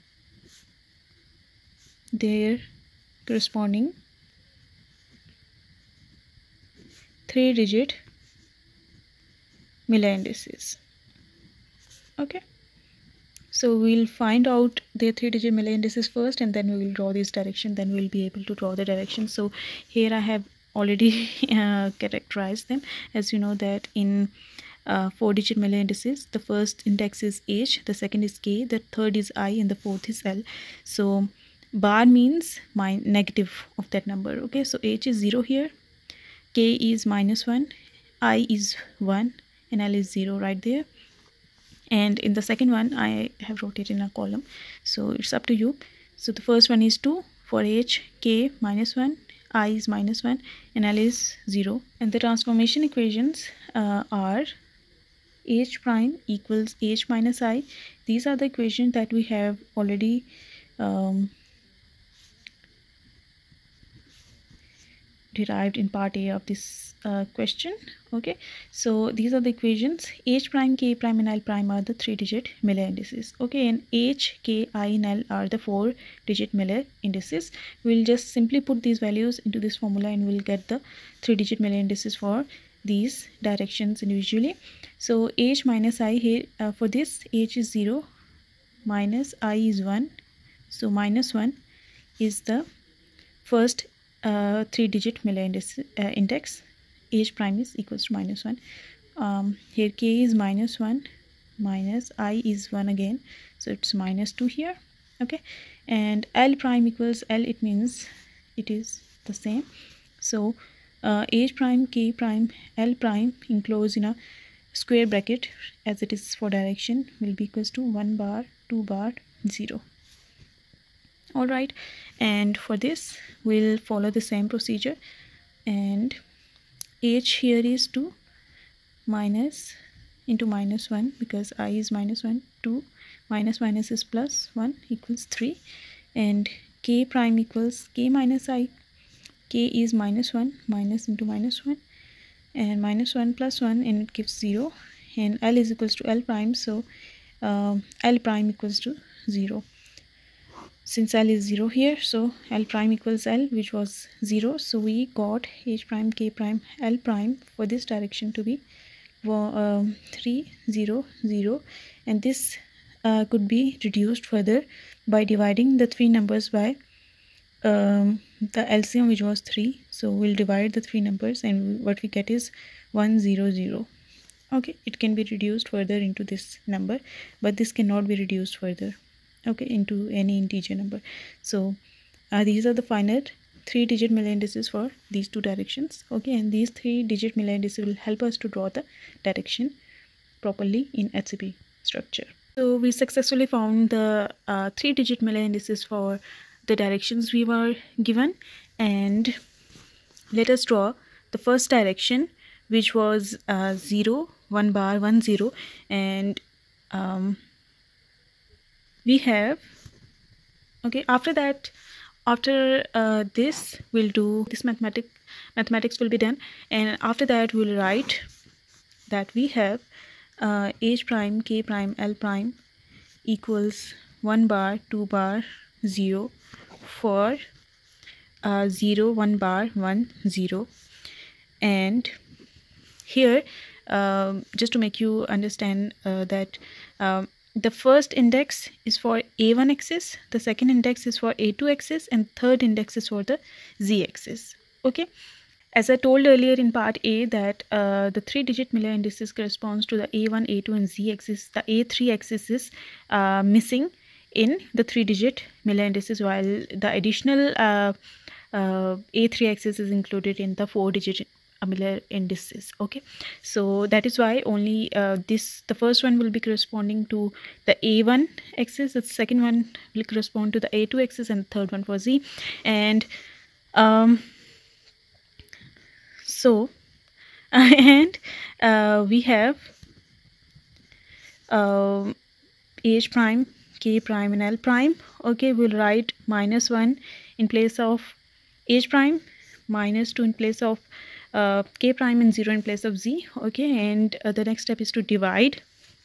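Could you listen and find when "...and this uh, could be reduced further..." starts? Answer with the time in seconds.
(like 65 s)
162 s.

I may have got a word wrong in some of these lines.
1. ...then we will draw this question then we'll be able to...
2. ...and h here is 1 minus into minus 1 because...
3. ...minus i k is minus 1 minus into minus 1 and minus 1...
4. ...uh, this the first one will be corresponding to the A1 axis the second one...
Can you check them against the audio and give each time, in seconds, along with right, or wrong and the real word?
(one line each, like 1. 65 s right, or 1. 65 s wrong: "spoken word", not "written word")
1. 16 s wrong: "direction", not "question"
2. 125 s wrong: "2", not "1"
3. 138 s right
4. 264 s right.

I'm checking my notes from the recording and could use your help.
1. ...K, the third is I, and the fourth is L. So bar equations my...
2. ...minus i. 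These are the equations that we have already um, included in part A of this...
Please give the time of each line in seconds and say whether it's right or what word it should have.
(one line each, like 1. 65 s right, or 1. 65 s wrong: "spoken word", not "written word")
1. 28 s wrong: "means", not "equations"
2. 57 s wrong: "derived", not "included".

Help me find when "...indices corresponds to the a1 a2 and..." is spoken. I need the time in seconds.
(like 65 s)
248 s.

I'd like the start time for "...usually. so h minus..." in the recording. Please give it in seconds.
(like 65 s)
84 s.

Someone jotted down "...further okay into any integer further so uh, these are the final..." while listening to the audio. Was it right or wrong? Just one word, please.
wrong.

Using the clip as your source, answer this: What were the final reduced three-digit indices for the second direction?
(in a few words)
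100.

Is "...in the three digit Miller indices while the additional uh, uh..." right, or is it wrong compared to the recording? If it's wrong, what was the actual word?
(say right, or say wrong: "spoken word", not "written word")
right.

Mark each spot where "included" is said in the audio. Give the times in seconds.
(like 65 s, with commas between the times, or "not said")
259 s.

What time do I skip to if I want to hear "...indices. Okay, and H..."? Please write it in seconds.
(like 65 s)
72 s.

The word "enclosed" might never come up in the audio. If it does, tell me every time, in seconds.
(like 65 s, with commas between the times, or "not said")
113 s.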